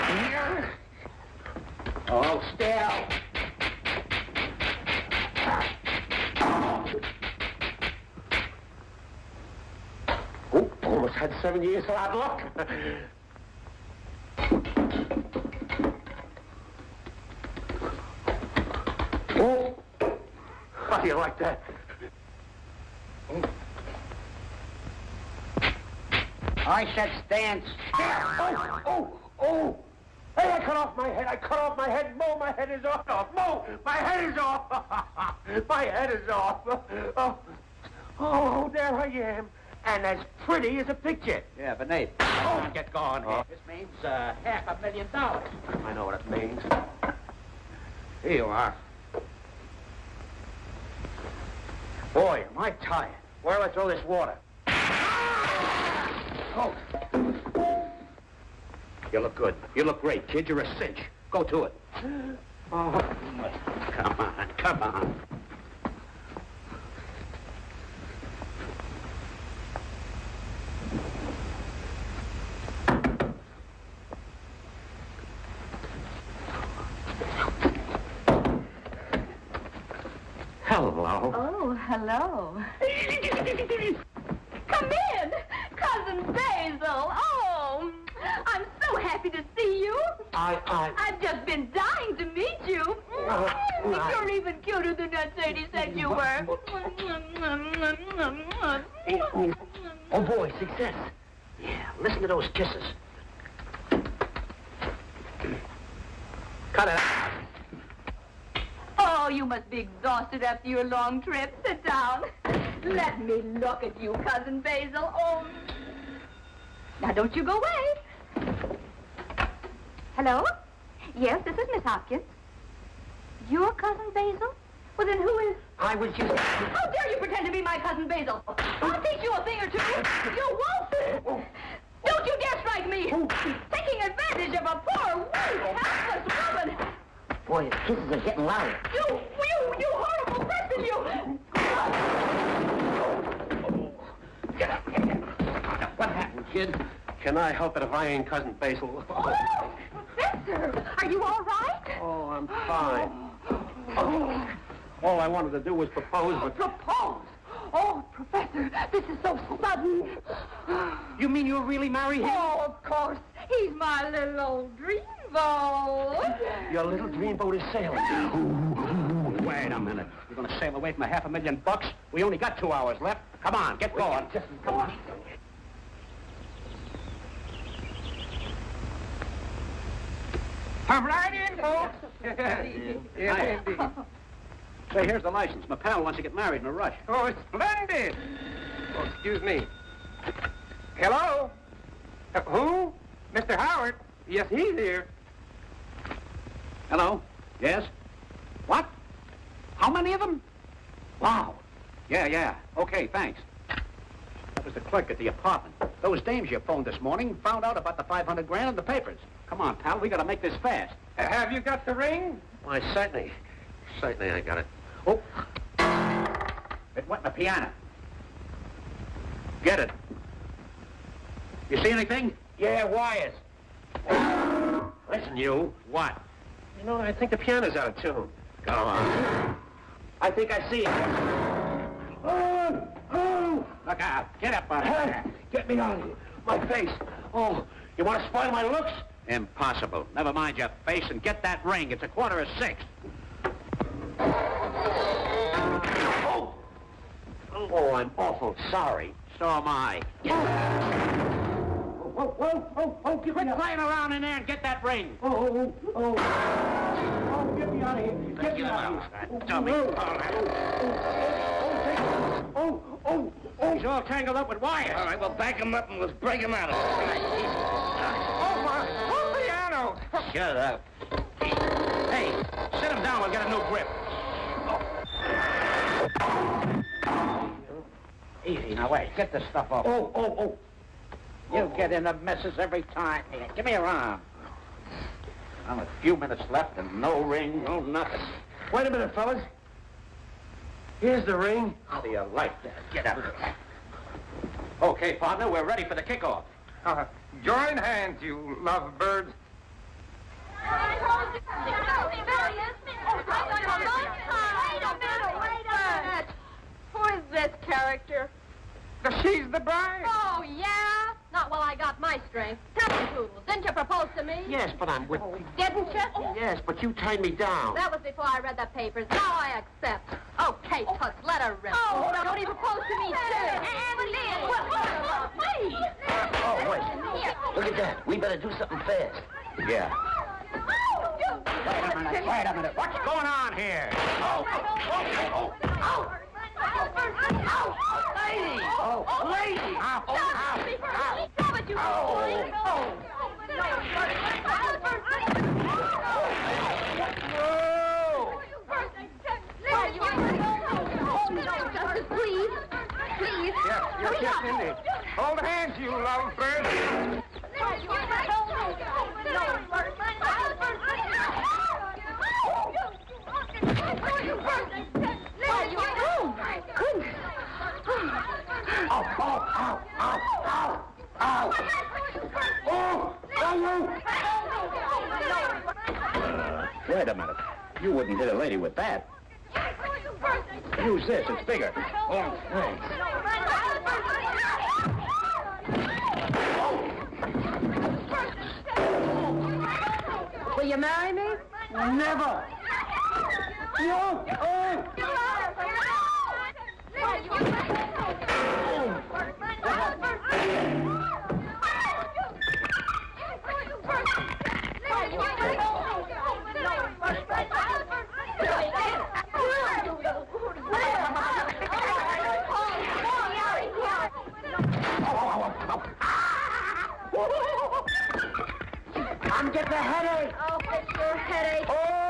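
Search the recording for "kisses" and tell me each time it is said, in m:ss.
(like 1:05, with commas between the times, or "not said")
1:42, 2:17.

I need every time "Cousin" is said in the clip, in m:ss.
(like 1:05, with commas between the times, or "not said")
1:25, 1:54, 2:03, 2:07, 2:28.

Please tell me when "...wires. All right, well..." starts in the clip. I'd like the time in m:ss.
4:24.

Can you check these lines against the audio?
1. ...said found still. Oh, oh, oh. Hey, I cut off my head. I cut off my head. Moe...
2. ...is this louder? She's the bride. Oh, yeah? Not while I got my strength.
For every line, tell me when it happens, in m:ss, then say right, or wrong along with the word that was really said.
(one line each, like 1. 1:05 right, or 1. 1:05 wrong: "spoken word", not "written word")
1. 0:26 wrong: "stand", not "found"
2. 5:07 wrong: "character", not "louder".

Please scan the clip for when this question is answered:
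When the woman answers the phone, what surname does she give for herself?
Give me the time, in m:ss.
2:01.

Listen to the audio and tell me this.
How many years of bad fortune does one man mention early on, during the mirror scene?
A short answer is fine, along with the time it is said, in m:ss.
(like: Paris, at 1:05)
7, at 0:11.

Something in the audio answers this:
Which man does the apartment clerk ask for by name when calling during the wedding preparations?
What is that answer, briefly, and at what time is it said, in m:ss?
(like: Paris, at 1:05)
Mr. Howard, at 3:13.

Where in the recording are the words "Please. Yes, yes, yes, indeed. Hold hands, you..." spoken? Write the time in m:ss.
5:53.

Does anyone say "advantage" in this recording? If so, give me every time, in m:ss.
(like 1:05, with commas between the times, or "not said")
2:14.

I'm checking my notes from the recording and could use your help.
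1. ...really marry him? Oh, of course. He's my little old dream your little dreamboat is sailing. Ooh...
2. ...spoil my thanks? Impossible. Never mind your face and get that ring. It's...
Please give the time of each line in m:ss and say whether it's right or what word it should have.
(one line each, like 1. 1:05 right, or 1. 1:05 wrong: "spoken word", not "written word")
1. 2:41 right
2. 3:58 wrong: "looks", not "thanks".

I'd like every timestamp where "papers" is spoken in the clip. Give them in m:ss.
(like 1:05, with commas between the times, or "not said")
3:28, 5:18.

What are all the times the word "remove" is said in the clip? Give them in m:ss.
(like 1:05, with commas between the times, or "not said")
not said.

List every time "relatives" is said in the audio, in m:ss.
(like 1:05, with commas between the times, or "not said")
not said.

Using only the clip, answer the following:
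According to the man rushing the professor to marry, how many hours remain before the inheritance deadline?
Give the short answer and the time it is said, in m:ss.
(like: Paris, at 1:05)
2, at 2:52.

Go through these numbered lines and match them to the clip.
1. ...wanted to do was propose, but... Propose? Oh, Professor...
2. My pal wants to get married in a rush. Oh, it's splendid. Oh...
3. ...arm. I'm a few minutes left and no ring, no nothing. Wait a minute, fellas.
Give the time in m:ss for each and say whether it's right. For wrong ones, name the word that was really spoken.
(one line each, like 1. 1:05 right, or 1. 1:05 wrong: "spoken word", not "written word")
1. 2:35 right
2. 3:05 right
3. 4:43 right.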